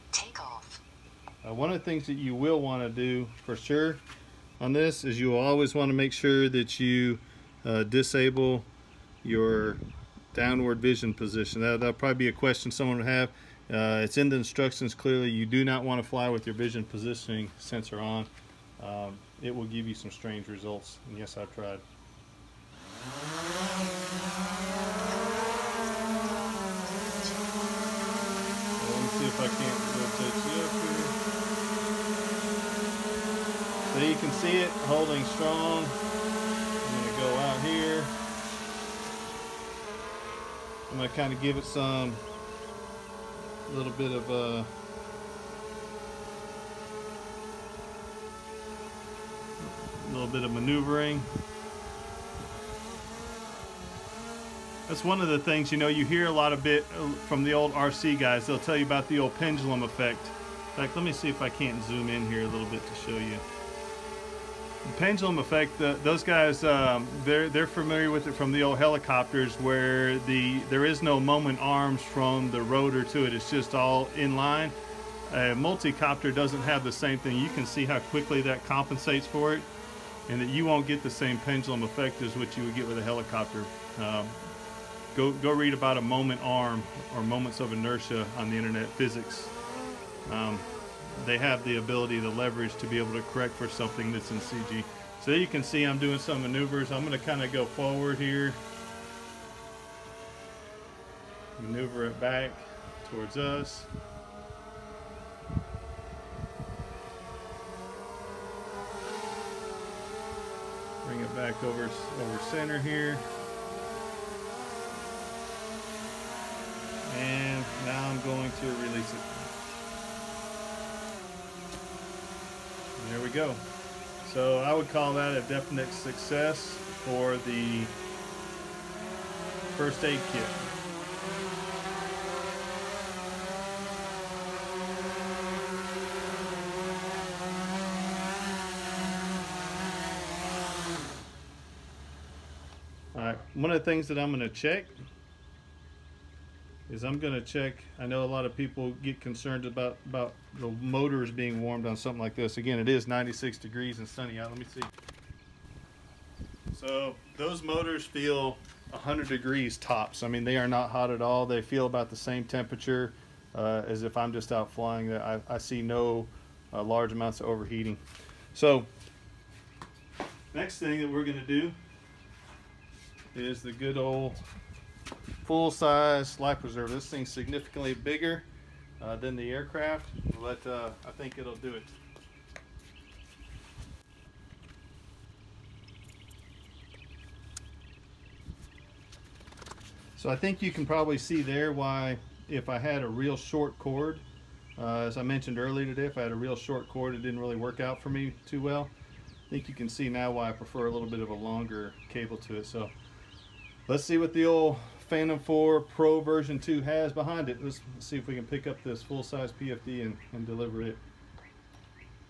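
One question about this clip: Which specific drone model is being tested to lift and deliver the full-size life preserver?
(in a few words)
Phantom 4 Pro version 2.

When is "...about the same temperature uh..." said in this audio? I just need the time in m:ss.
2:41.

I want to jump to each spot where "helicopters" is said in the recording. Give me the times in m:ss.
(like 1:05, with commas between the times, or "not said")
1:08, 1:23.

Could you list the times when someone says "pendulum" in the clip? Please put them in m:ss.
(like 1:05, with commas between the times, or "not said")
0:59, 1:04, 1:21.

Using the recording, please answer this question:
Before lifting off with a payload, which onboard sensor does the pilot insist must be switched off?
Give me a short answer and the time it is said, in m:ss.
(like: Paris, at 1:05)
Downward vision position, at 0:10.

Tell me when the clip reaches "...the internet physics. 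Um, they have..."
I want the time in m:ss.
1:28.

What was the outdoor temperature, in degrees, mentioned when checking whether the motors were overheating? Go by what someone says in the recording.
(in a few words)
96.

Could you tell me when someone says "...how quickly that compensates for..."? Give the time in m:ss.
1:17.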